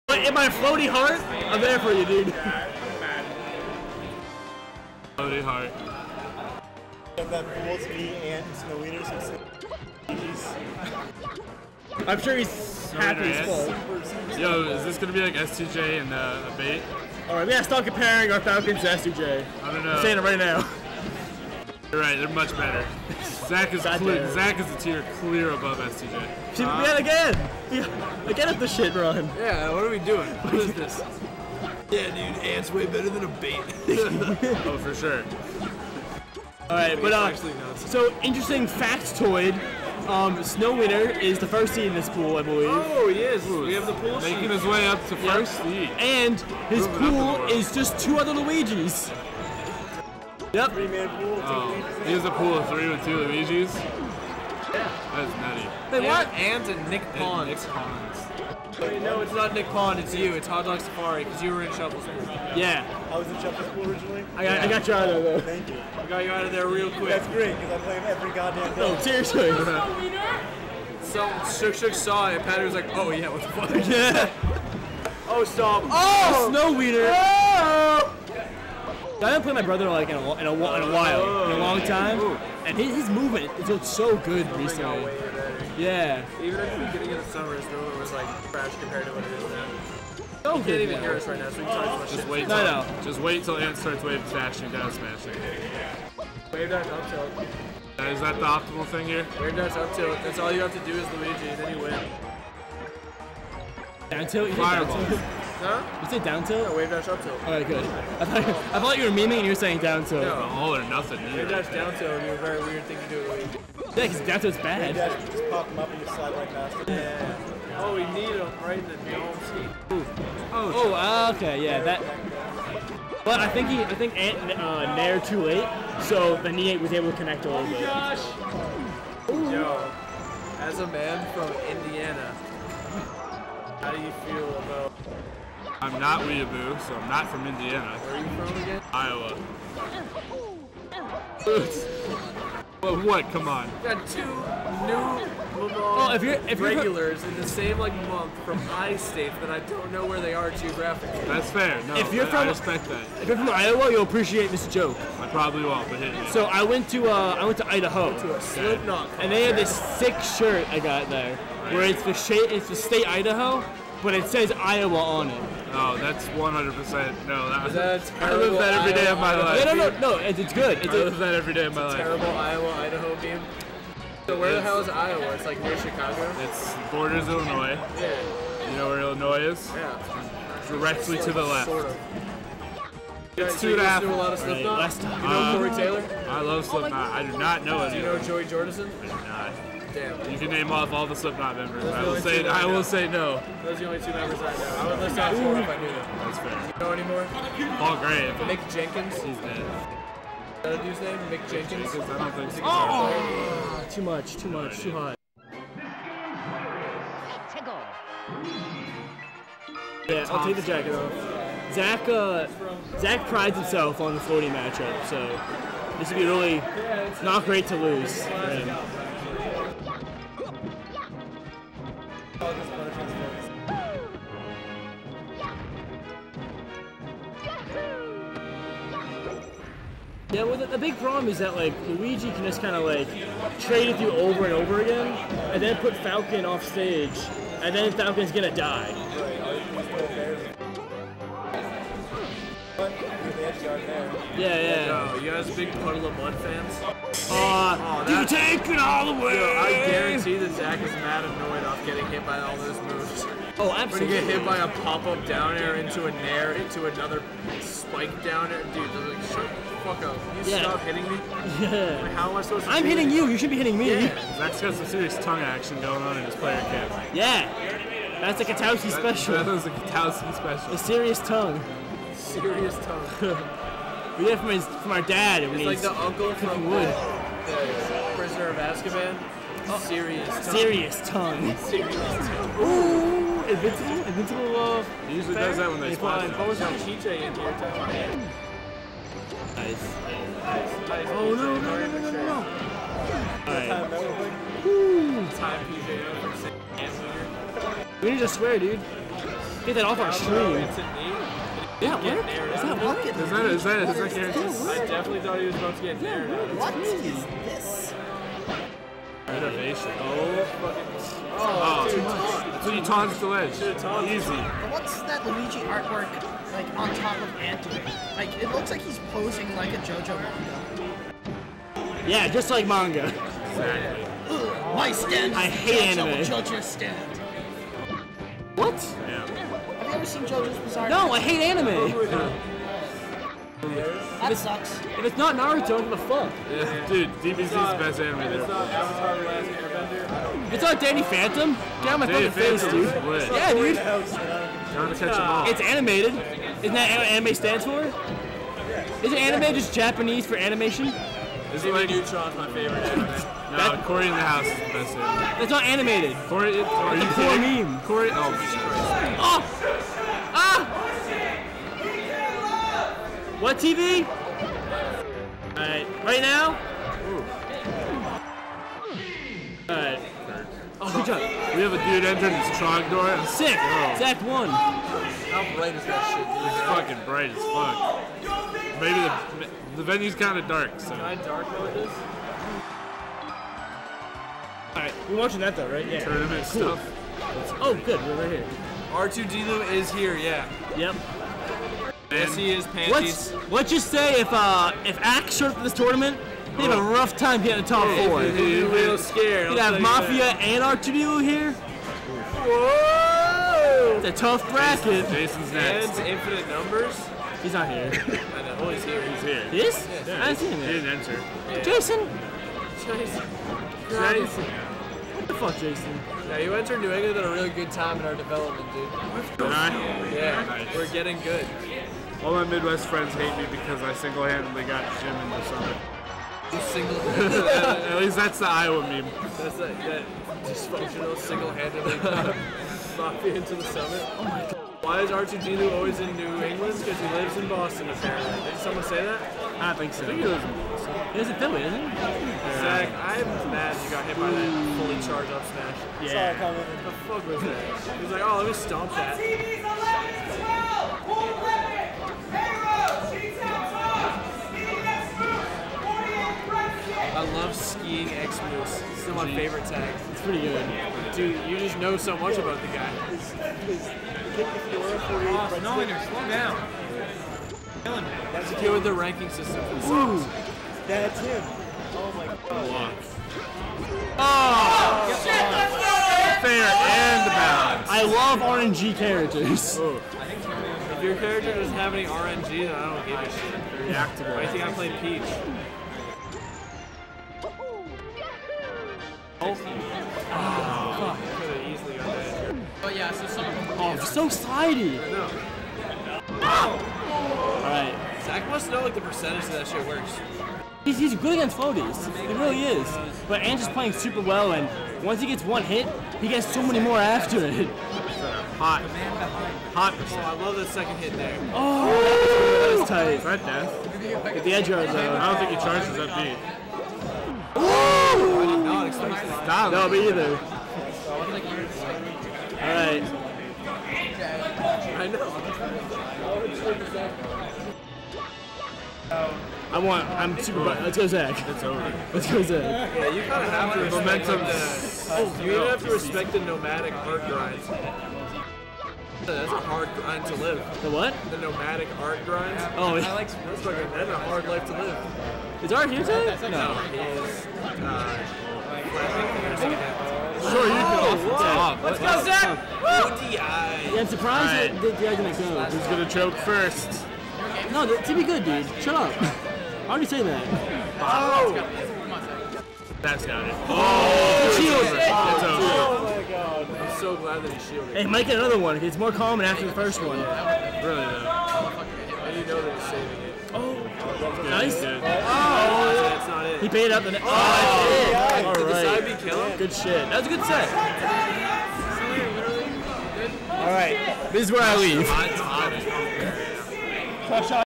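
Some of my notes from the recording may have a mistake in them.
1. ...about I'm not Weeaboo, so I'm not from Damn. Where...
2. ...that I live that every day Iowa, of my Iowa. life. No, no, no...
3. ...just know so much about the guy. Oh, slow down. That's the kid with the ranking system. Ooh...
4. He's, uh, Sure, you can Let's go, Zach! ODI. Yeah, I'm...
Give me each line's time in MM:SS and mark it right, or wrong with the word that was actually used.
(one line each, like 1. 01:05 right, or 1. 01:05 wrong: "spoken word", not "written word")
1. 02:14 wrong: "Indiana", not "Damn"
2. 02:47 right
3. 07:41 right
4. 09:06 right.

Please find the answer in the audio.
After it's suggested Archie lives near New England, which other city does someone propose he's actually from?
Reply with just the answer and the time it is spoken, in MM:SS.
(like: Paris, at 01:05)
Philly, at 07:21.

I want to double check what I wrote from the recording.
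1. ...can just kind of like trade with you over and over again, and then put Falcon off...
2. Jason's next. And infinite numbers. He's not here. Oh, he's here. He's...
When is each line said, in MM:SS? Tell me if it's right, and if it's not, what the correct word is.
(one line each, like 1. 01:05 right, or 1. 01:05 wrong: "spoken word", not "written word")
1. 03:52 right
2. 06:45 right.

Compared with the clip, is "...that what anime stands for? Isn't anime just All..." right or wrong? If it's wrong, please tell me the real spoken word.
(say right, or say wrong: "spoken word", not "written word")
wrong: "Japanese", not "All".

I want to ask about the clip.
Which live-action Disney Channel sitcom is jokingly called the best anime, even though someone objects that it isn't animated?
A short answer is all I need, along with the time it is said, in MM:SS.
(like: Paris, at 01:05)
Cory in the House, at 05:53.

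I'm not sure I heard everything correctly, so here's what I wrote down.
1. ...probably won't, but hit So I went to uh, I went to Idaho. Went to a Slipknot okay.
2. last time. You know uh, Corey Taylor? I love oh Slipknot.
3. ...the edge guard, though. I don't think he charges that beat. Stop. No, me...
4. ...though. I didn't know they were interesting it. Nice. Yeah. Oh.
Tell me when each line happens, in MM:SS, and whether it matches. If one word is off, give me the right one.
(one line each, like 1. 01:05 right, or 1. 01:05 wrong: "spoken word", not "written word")
1. 02:35 right
2. 03:04 right
3. 08:34 right
4. 09:30 wrong: "saving", not "interesting".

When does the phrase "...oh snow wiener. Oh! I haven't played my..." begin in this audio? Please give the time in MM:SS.
01:16.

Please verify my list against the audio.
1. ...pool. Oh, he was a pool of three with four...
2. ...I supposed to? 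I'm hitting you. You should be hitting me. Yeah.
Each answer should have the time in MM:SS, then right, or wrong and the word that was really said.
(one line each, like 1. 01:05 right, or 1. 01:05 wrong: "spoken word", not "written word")
1. 00:51 wrong: "two", not "four"
2. 04:22 right.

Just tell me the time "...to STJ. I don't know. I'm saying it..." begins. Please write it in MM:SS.
00:18.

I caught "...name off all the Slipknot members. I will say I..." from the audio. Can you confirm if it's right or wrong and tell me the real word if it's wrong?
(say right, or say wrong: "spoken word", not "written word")
right.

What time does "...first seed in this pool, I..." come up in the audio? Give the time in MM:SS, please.
00:41.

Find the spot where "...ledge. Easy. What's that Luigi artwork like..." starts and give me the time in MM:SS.
05:13.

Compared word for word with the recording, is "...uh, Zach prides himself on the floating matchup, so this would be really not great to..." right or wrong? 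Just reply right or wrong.
right.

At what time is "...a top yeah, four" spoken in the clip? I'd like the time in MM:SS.
06:37.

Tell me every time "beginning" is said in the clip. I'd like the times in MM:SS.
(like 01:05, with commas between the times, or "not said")
01:26.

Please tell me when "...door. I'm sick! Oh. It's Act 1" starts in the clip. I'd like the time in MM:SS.
06:12.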